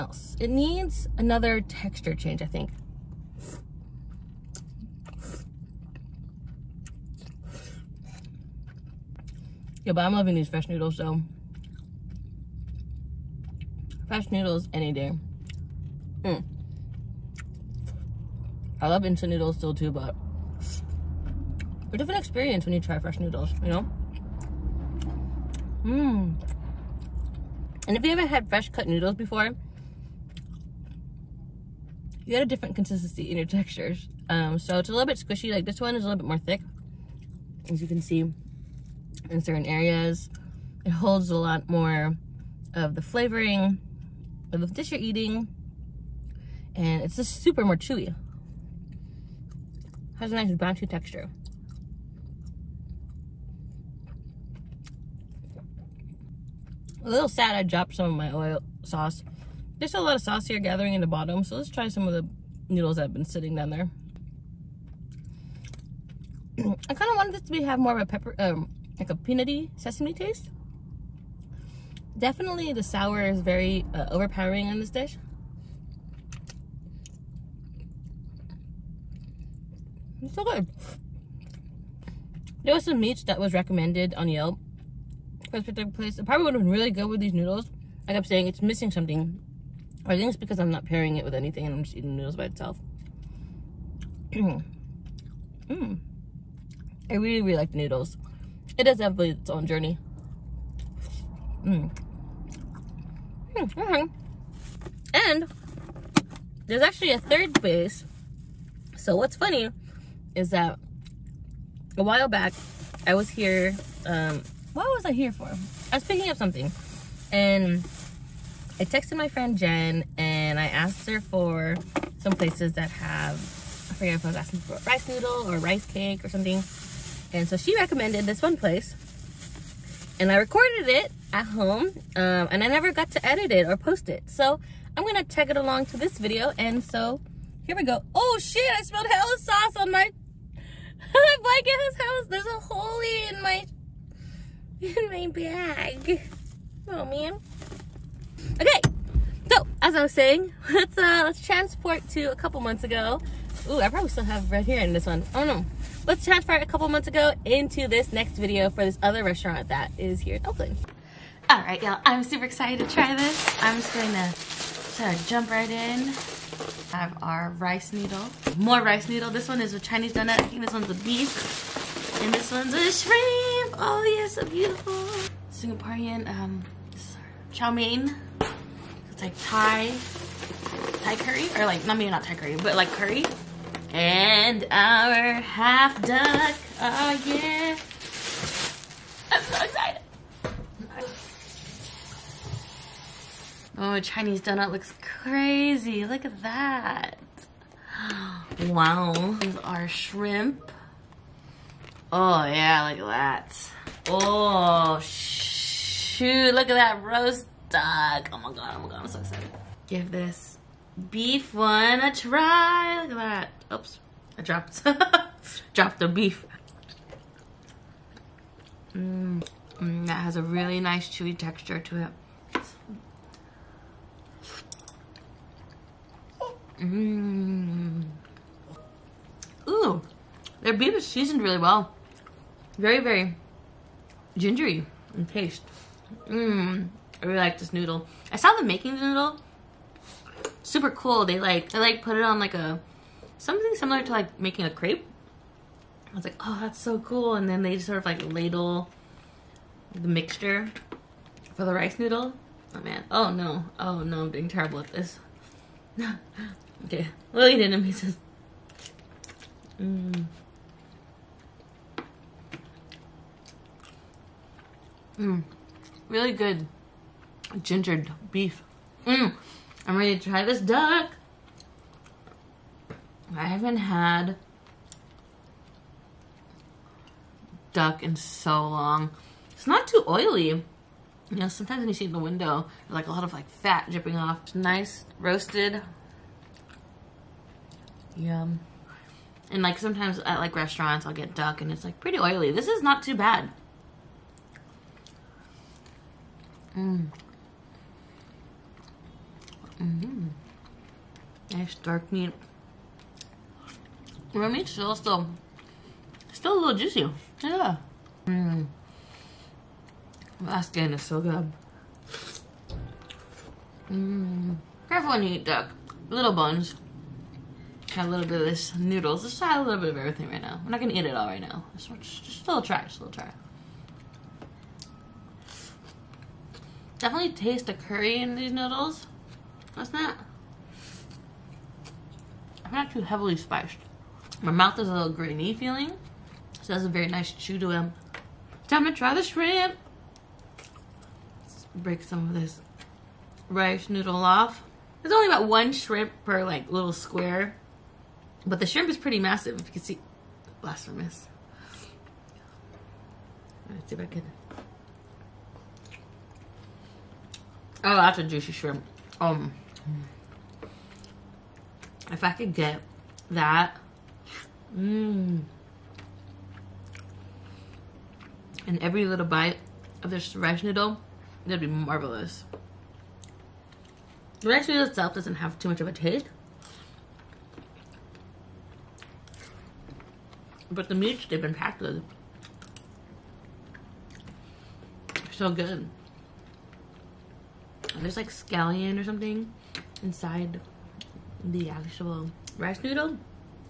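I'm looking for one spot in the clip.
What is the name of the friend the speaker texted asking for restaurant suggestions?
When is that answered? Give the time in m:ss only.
1:59.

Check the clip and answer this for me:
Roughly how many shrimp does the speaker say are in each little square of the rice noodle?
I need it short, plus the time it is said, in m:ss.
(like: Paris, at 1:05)
1, at 5:45.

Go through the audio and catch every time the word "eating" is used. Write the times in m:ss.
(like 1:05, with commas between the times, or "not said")
0:44, 1:31.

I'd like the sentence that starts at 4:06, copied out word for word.
I was like, oh, that's so cool.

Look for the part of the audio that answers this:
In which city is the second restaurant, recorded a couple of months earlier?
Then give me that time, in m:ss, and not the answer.
2:40.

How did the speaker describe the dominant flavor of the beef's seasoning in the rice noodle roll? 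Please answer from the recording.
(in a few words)
Very gingery.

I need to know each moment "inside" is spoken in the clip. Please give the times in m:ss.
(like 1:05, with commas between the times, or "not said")
6:30.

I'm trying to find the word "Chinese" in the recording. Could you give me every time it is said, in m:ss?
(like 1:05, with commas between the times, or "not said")
2:49, 3:14.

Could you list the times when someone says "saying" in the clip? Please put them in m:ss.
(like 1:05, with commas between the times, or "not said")
1:28, 2:30.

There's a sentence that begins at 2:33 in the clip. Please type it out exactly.
Ooh, I probably still have right here in this one.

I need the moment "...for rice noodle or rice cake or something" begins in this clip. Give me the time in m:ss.
2:04.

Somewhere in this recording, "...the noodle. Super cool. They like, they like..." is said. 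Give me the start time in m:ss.
3:58.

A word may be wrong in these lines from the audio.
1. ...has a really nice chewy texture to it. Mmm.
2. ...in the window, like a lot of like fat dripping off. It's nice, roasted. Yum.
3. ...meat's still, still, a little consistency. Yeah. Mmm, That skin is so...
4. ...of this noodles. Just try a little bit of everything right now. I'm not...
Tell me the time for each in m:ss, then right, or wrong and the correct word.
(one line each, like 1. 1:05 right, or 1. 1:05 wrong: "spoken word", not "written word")
1. 3:40 right
2. 4:42 right
3. 5:04 wrong: "juicy", not "consistency"
4. 5:18 right.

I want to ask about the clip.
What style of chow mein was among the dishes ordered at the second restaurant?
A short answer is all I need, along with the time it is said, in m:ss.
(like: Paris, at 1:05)
Singaporean, at 2:55.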